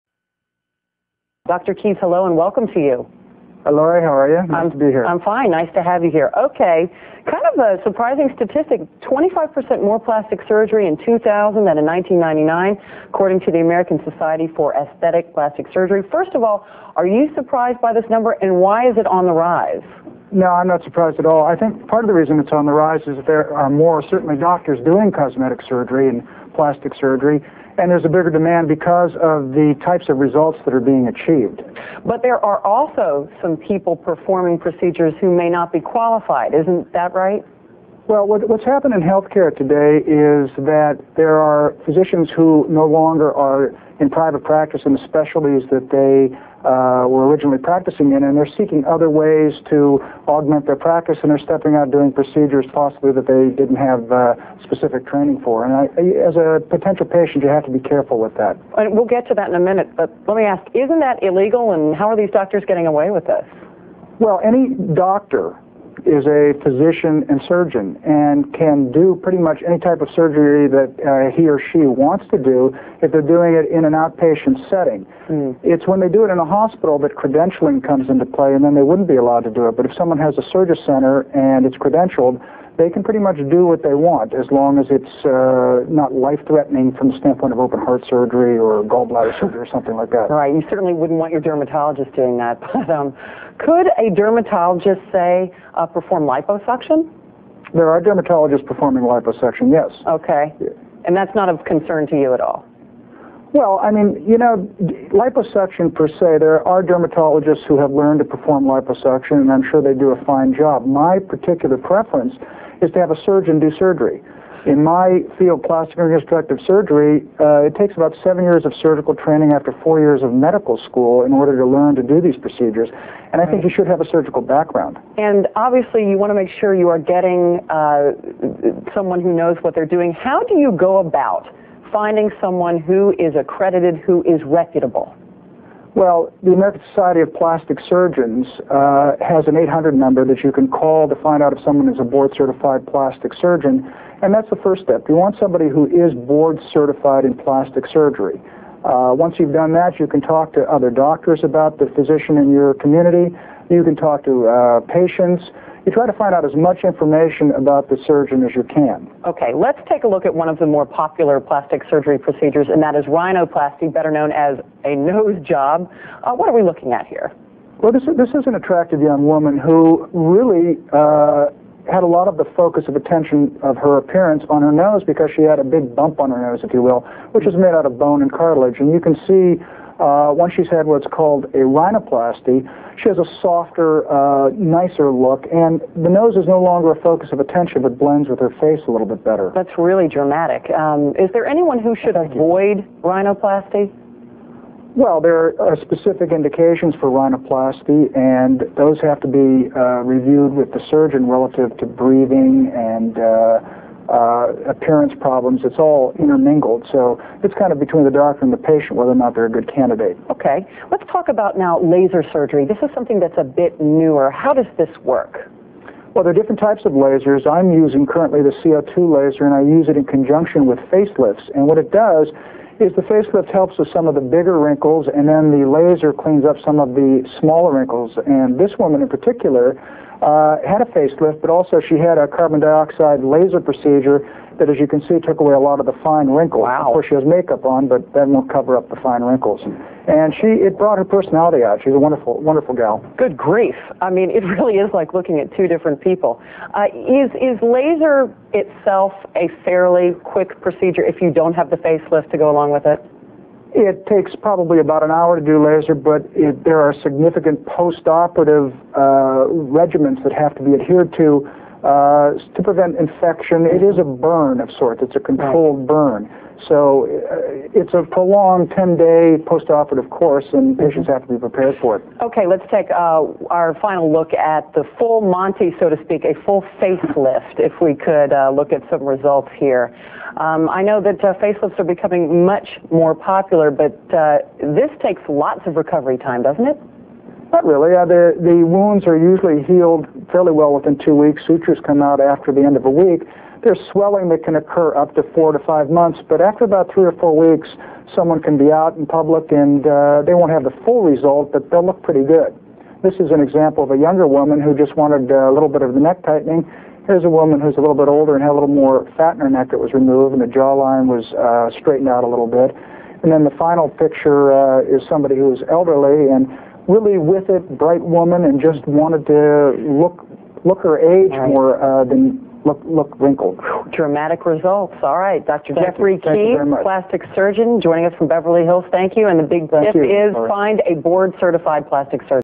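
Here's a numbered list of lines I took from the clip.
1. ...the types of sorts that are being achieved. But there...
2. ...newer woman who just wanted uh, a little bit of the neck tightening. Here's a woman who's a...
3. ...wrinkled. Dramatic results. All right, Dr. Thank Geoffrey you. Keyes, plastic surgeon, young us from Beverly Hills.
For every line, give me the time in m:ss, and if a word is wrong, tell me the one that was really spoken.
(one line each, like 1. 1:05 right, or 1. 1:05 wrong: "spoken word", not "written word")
1. 0:29 wrong: "results", not "sorts"
2. 5:03 wrong: "younger", not "newer"
3. 5:23 wrong: "joining", not "young".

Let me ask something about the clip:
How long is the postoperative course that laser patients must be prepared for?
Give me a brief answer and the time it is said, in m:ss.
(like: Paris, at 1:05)
10 days, at 4:28.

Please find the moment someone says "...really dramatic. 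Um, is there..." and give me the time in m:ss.
3:09.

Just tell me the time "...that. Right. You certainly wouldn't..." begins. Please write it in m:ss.
1:30.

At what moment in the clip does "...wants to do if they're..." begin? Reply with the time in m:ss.
1:11.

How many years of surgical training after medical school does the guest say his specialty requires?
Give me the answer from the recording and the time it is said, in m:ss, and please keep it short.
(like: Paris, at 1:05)
7, at 1:58.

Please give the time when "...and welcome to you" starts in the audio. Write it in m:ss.
0:02.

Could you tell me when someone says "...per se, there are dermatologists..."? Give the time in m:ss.
1:45.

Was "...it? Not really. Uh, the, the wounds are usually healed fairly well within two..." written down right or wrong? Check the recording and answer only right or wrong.
right.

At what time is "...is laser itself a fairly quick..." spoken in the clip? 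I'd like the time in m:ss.
4:07.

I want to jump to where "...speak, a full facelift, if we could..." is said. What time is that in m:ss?
4:36.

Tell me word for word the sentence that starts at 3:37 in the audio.
I'm using currently the CO2 laser, and I use it in conjunction with facelifts.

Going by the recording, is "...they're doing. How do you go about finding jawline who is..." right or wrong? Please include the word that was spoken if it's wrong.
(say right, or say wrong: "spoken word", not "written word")
wrong: "someone", not "jawline".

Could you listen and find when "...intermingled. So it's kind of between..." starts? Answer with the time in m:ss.
3:26.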